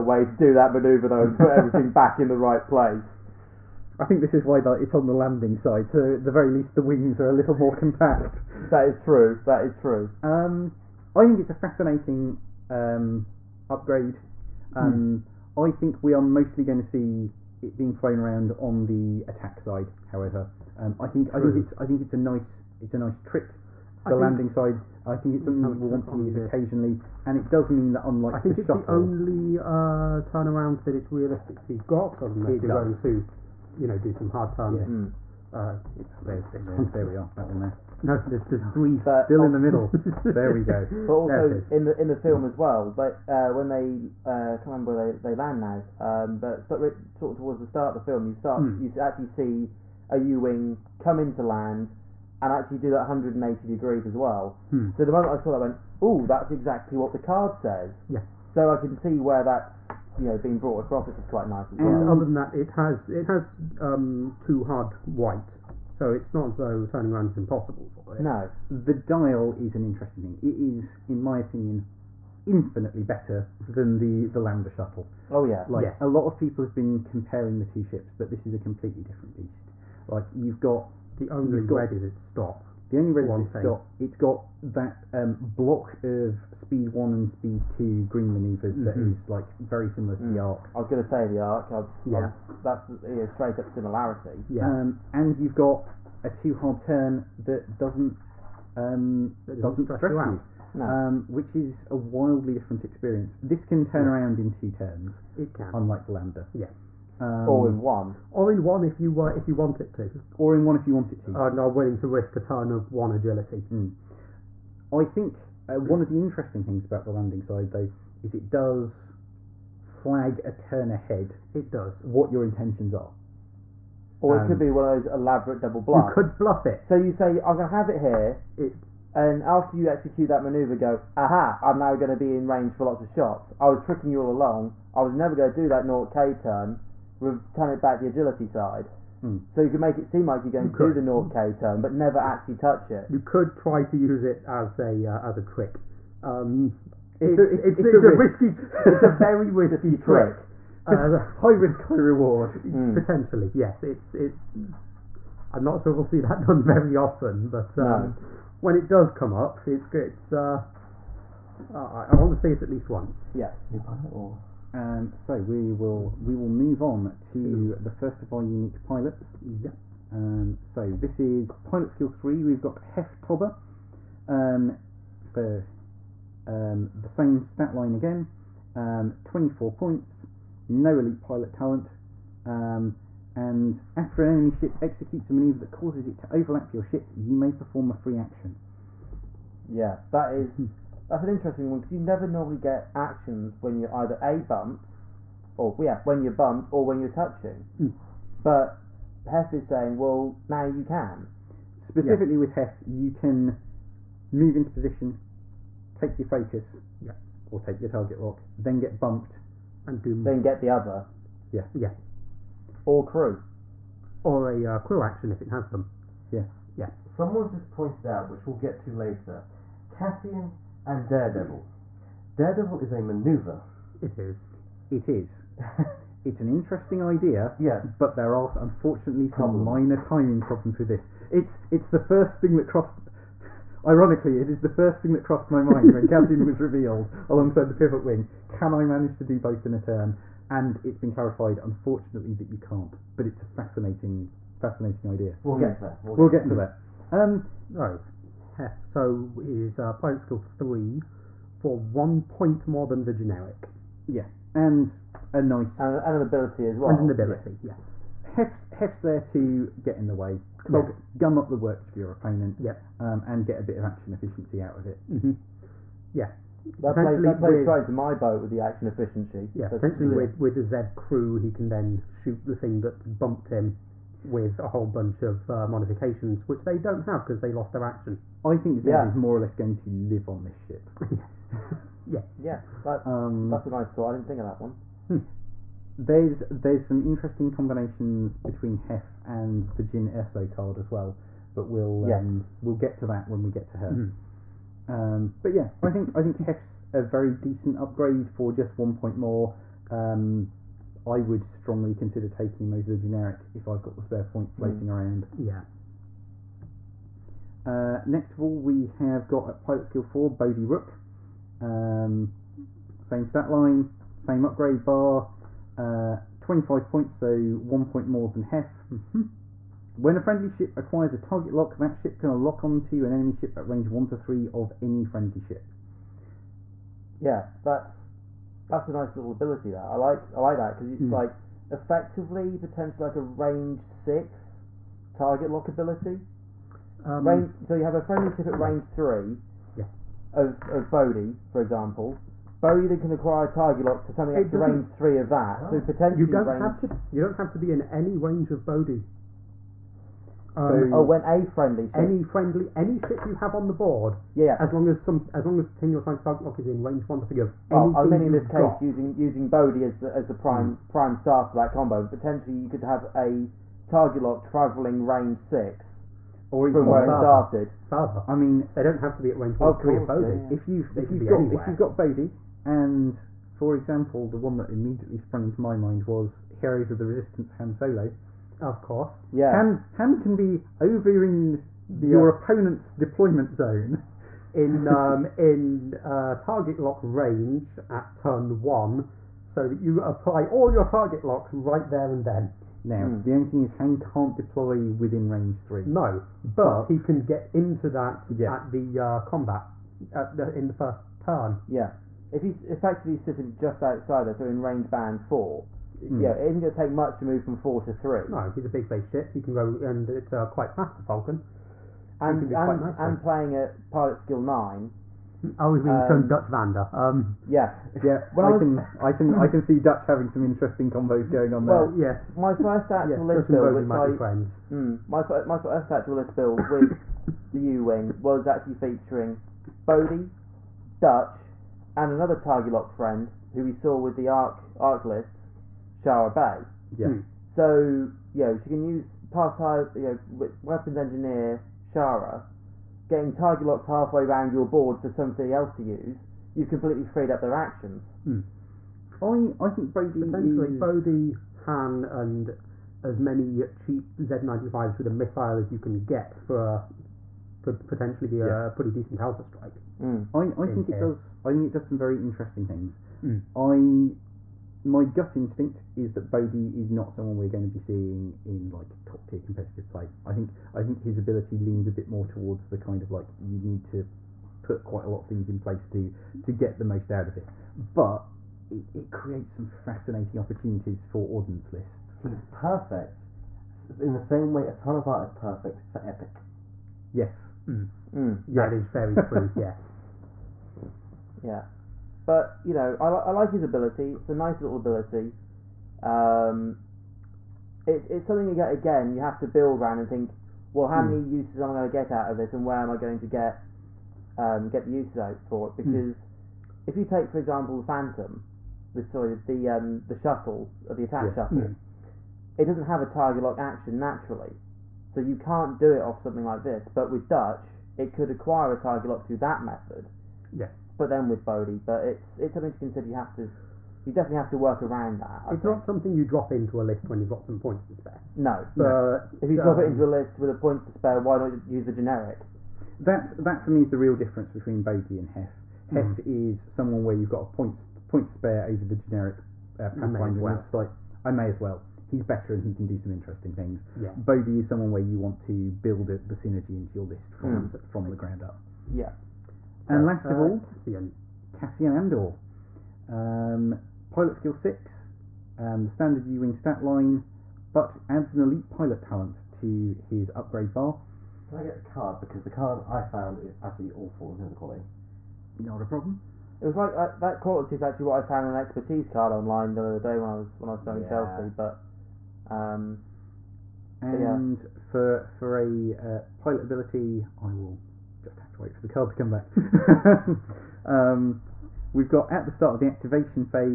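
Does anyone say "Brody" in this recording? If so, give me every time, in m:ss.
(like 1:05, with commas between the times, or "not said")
7:29.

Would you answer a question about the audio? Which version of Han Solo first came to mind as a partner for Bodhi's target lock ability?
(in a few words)
Heroes of the Resistance.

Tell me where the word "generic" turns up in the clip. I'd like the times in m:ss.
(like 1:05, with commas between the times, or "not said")
4:13, 5:02, 8:51, 8:58.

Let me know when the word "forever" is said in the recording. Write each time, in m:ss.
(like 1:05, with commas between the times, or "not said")
not said.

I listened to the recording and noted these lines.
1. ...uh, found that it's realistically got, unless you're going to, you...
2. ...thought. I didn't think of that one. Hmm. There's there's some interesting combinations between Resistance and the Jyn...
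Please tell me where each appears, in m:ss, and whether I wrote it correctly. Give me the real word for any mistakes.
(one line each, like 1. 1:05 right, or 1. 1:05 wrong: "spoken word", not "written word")
1. 0:29 wrong: "turnaround", not "found"
2. 4:43 wrong: "Hef", not "Resistance".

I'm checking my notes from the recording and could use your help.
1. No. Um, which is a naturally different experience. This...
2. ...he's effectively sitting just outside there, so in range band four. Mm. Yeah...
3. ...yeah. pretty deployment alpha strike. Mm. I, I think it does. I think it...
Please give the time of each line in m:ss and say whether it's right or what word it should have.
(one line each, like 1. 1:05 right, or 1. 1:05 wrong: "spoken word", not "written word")
1. 1:40 wrong: "wildly", not "naturally"
2. 6:42 right
3. 7:38 wrong: "decent", not "deployment".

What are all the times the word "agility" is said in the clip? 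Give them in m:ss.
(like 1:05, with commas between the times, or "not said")
1:53, 2:18.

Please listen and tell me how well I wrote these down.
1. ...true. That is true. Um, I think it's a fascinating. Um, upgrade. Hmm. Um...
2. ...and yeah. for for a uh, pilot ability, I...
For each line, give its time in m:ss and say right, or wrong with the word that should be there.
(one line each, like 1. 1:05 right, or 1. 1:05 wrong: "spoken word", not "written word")
1. 0:08 right
2. 9:33 right.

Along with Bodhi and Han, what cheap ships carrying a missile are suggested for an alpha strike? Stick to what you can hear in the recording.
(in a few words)
Z95s.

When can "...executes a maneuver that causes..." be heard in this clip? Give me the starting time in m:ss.
3:04.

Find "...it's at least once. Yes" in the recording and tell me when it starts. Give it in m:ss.
2:42.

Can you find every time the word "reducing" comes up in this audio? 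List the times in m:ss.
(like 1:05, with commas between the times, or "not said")
not said.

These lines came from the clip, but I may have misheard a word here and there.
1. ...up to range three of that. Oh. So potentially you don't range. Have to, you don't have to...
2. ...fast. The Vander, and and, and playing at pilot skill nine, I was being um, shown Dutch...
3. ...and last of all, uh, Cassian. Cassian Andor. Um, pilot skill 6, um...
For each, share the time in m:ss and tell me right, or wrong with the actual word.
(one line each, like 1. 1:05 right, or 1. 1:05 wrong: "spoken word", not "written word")
1. 5:44 right
2. 6:50 wrong: "Falcon", not "Vander"
3. 9:09 right.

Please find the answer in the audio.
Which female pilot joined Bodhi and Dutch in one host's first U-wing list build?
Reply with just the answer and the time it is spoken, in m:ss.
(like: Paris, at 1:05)
Shara Bey, at 7:15.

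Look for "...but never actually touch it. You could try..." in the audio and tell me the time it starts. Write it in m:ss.
2:21.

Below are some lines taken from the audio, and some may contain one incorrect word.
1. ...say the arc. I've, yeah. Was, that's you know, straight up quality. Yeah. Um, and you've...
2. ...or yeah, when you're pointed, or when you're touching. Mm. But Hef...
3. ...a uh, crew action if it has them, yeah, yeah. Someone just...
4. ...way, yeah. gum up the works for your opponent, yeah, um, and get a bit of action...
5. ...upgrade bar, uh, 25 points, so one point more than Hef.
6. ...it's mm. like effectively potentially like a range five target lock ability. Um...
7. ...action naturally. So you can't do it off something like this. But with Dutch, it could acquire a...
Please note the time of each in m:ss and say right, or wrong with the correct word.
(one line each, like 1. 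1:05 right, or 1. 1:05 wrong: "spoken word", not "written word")
1. 1:31 wrong: "similarity", not "quality"
2. 3:15 wrong: "bumped", not "pointed"
3. 3:34 right
4. 4:20 right
5. 5:14 right
6. 5:30 wrong: "six", not "five"
7. 8:33 right.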